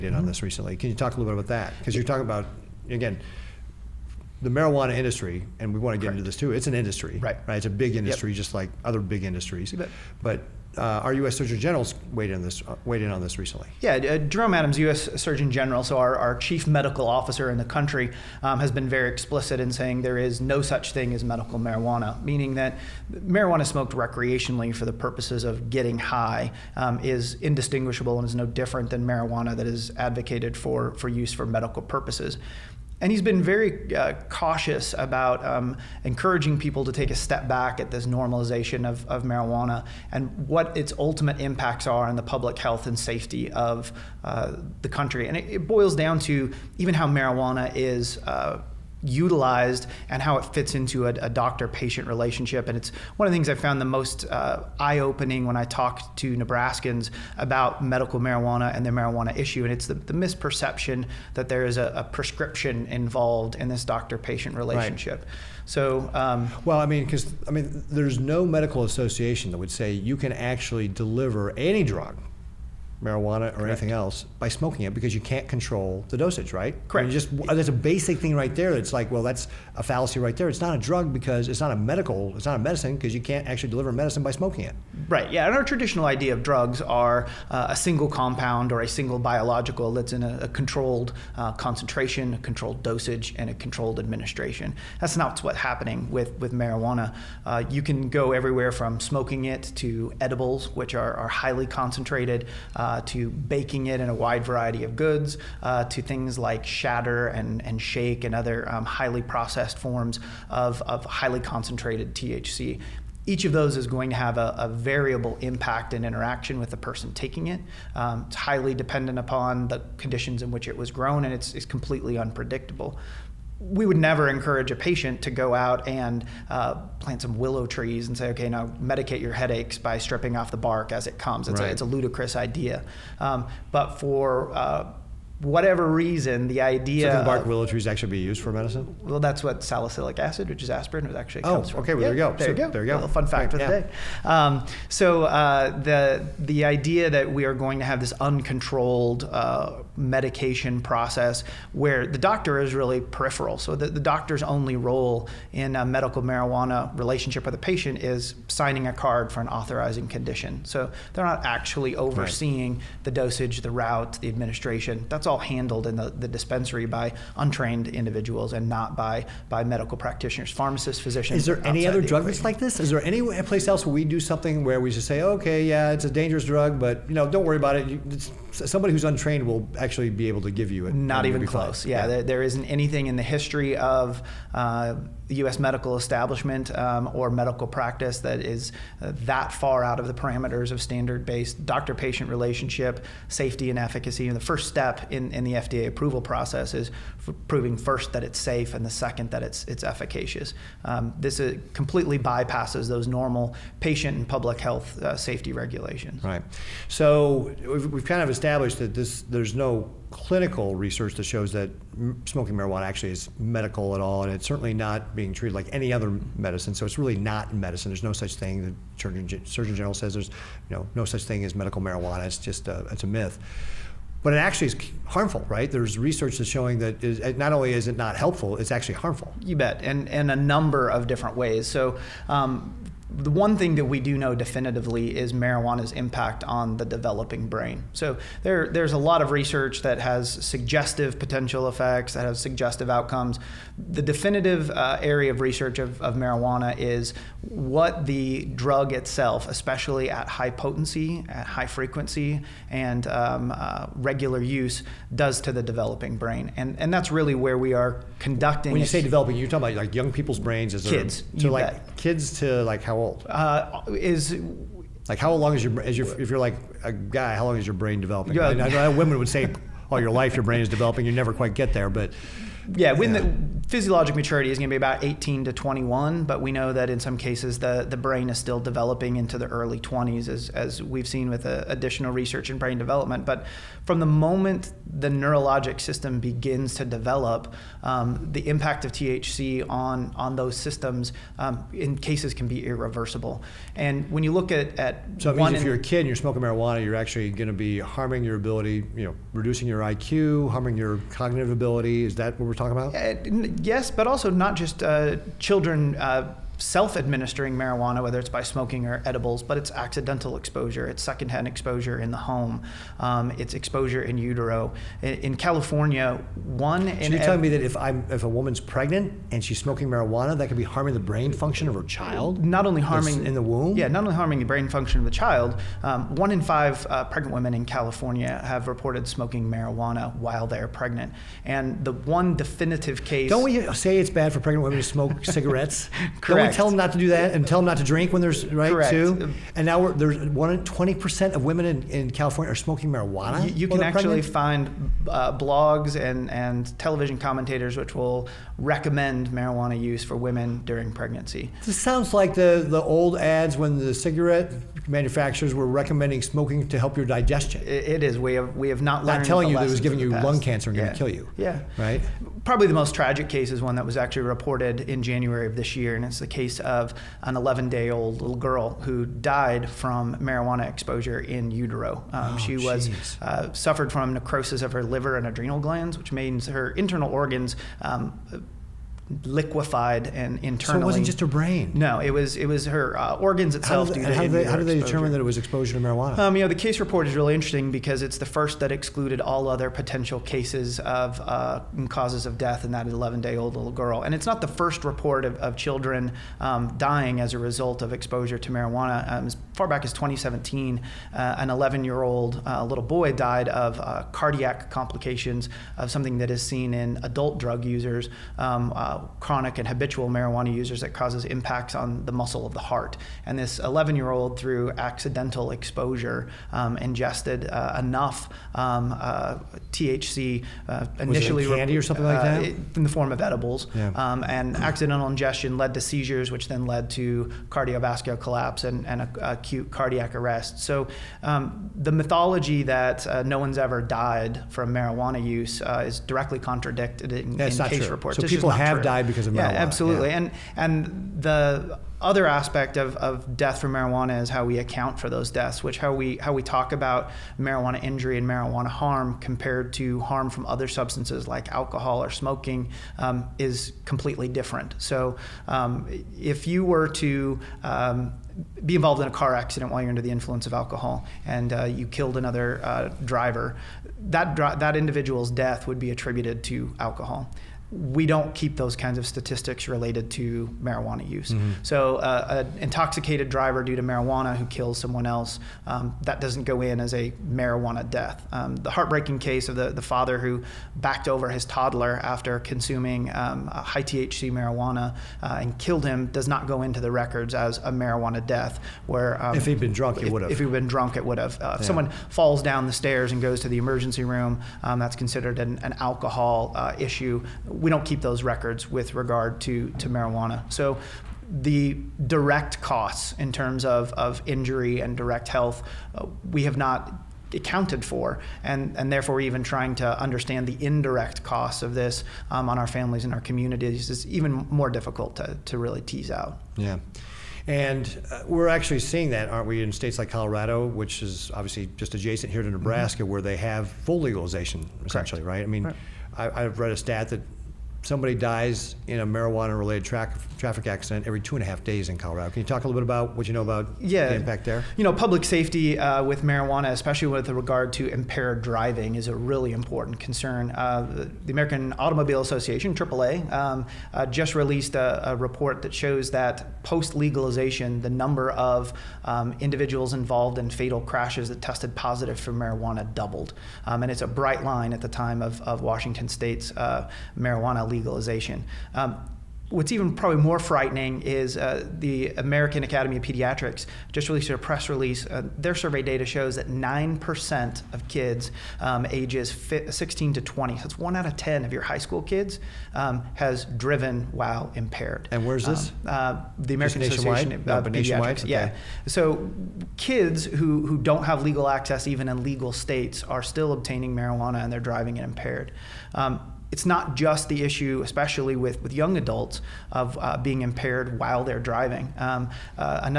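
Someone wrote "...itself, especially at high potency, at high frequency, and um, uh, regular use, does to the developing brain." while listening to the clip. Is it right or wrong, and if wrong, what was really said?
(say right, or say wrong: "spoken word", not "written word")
right.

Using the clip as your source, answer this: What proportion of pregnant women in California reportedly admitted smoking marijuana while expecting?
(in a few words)
One in five.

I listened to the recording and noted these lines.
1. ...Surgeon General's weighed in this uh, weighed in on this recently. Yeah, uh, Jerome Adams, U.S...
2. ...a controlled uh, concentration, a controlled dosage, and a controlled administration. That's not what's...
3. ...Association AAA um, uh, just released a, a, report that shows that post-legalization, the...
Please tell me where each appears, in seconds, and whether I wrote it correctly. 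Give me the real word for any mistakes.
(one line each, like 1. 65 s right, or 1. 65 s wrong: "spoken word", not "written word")
1. 11 s right
2. 90 s right
3. 542 s right.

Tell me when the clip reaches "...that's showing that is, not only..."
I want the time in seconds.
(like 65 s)
226 s.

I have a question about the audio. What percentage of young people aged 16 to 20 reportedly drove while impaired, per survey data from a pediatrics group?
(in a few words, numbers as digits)
9%.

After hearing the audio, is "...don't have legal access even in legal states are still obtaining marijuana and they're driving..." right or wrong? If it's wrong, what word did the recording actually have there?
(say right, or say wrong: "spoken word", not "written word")
right.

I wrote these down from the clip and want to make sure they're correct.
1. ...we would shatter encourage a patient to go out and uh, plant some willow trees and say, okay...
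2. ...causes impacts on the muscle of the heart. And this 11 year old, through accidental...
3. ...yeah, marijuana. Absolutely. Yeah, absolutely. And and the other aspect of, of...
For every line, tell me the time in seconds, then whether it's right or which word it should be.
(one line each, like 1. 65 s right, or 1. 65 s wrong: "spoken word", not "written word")
1. 123 s wrong: "never", not "shatter"
2. 410 s right
3. 439 s right.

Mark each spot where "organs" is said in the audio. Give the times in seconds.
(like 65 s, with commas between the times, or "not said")
377 s, 383 s.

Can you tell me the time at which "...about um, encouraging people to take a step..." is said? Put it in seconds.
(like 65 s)
34 s.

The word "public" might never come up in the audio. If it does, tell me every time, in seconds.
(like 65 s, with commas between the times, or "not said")
42 s, 204 s, 534 s.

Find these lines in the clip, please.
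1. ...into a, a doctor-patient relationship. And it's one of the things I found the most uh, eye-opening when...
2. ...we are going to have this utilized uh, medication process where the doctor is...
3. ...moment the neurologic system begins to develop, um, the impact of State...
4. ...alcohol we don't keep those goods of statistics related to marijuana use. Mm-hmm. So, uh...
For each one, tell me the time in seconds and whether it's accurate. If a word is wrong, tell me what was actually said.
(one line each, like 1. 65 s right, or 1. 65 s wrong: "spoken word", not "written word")
1. 50 s right
2. 147 s wrong: "uncontrolled", not "utilized"
3. 284 s wrong: "THC", not "State"
4. 466 s wrong: "kinds", not "goods".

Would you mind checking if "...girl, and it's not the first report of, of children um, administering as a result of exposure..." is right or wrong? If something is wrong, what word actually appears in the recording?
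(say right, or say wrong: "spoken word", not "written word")
wrong: "dying", not "administering".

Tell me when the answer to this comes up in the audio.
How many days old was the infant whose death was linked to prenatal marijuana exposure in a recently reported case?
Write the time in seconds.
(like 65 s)
367 s.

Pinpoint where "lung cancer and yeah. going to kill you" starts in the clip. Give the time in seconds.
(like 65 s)
360 s.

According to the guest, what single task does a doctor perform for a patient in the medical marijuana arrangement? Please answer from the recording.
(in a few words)
Signing a card.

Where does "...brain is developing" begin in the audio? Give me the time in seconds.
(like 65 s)
270 s.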